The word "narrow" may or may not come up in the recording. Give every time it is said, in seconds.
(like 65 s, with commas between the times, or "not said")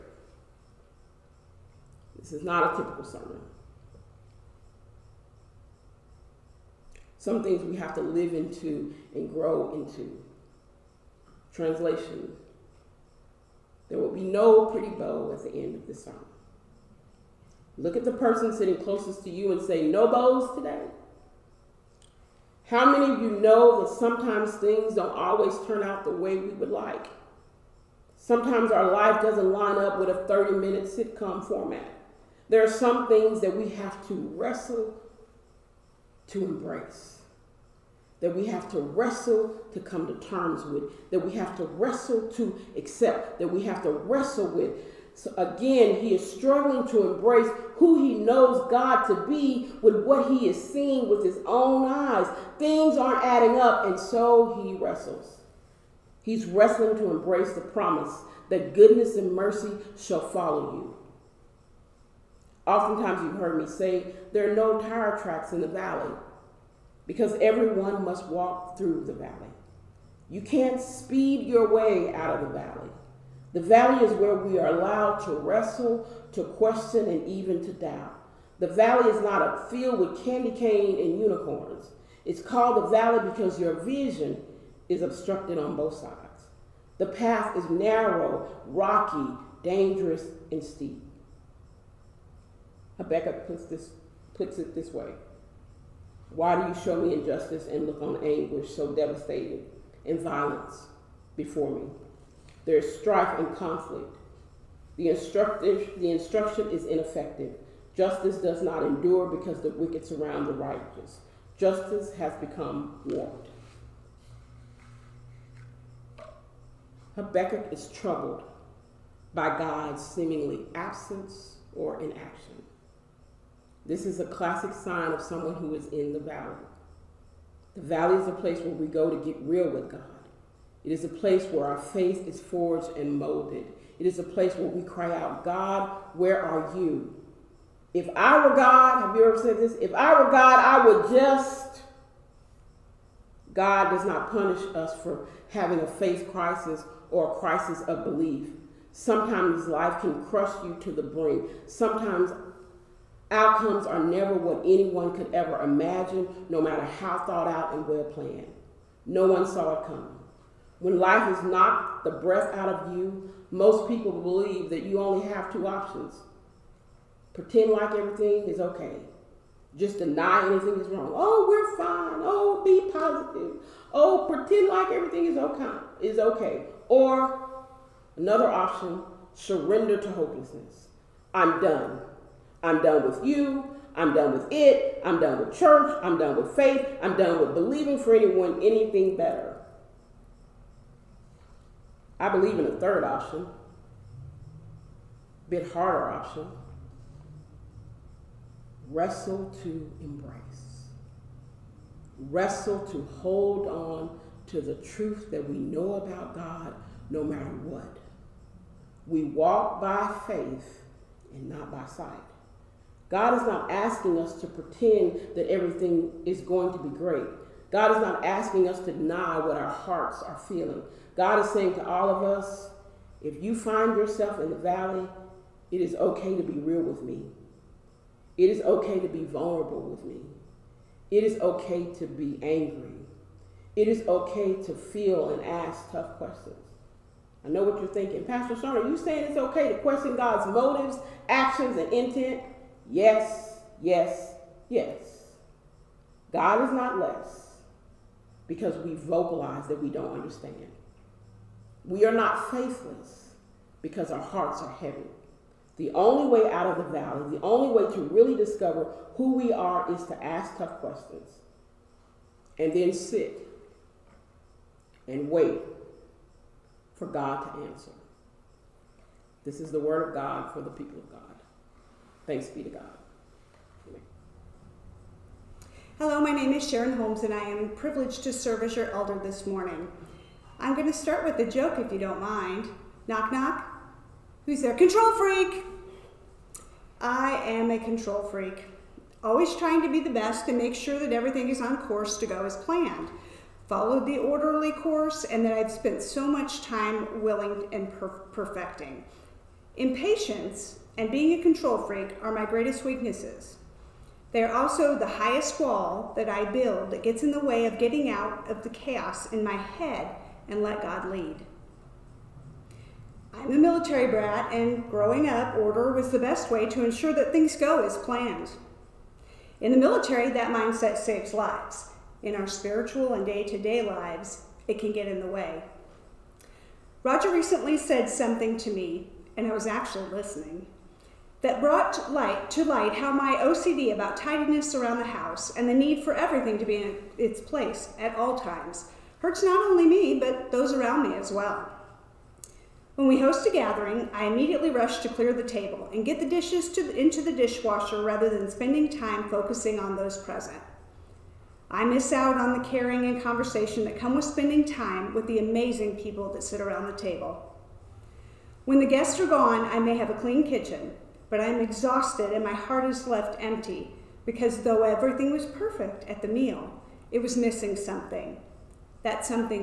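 87 s.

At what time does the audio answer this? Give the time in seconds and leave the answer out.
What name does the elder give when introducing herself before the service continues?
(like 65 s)
276 s.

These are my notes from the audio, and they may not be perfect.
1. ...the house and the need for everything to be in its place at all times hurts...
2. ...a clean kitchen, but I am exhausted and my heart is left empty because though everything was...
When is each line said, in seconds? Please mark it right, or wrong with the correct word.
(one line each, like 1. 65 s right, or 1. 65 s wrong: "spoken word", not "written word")
1. 334 s right
2. 360 s right.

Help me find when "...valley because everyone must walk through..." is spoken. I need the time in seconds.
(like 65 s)
65 s.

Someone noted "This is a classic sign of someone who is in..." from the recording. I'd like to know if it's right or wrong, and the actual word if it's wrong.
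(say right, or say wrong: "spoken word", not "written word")
right.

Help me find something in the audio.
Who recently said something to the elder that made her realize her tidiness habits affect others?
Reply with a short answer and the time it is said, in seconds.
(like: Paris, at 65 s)
Roger, at 327 s.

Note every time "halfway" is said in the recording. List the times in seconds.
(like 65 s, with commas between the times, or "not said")
not said.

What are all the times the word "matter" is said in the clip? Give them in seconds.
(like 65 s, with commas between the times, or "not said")
156 s, 207 s.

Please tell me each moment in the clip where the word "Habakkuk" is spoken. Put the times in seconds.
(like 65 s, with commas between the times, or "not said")
92 s, 117 s.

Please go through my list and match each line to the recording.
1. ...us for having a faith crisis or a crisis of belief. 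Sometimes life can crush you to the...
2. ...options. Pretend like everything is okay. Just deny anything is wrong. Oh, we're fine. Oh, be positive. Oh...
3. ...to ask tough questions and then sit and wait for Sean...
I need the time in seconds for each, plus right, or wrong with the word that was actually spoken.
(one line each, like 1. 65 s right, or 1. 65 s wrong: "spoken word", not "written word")
1. 144 s right
2. 165 s right
3. 260 s wrong: "God", not "Sean".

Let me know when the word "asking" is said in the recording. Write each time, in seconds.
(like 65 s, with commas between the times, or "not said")
213 s, 218 s.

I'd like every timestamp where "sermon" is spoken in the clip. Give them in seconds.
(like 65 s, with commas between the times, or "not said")
3 s, 15 s.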